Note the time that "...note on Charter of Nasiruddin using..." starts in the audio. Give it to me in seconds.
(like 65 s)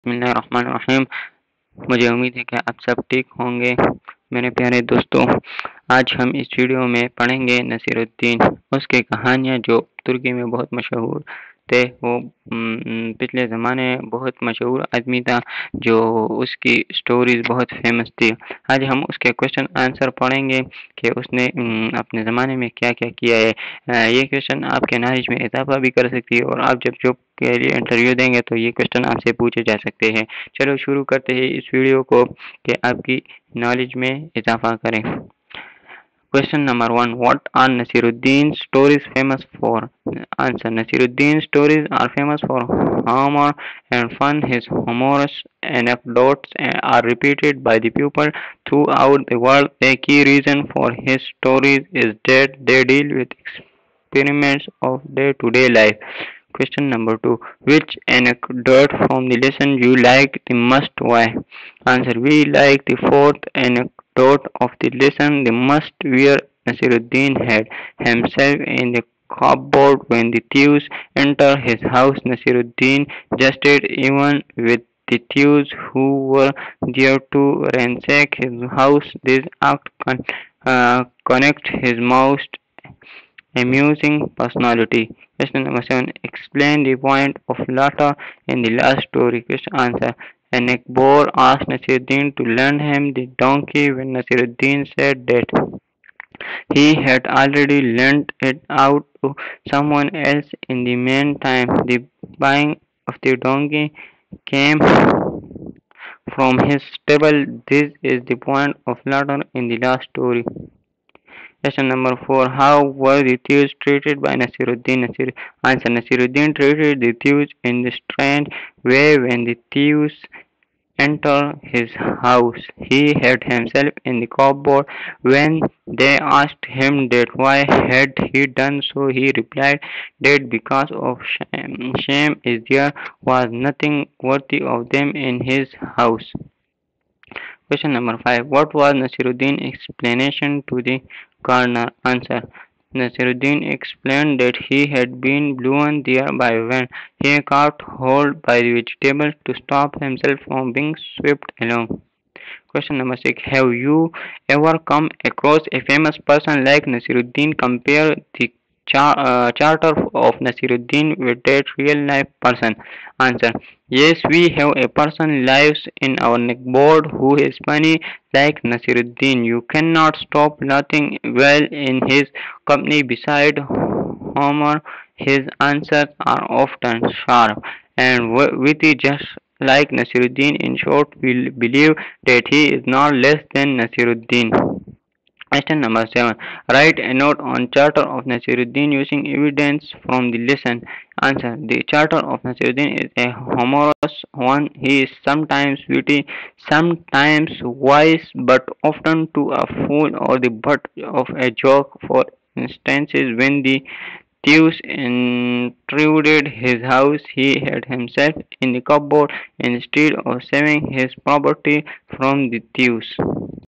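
187 s.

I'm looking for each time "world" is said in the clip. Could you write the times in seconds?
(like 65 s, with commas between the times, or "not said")
49 s.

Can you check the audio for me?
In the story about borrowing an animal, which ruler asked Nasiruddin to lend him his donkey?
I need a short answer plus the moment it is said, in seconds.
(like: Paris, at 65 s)
Akbar, at 90 s.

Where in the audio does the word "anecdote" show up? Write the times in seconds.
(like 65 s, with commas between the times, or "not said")
45 s, 58 s, 63 s.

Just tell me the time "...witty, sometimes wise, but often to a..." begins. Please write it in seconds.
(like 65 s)
195 s.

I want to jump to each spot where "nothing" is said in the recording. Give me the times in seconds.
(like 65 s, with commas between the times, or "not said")
133 s, 170 s.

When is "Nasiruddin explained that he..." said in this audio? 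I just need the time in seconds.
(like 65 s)
142 s.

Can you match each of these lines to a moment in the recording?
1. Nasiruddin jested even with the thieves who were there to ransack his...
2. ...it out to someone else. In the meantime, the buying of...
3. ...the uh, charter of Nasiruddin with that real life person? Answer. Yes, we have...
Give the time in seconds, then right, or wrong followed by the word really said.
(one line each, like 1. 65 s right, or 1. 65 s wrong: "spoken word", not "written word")
1. 72 s right
2. 98 s right
3. 158 s right.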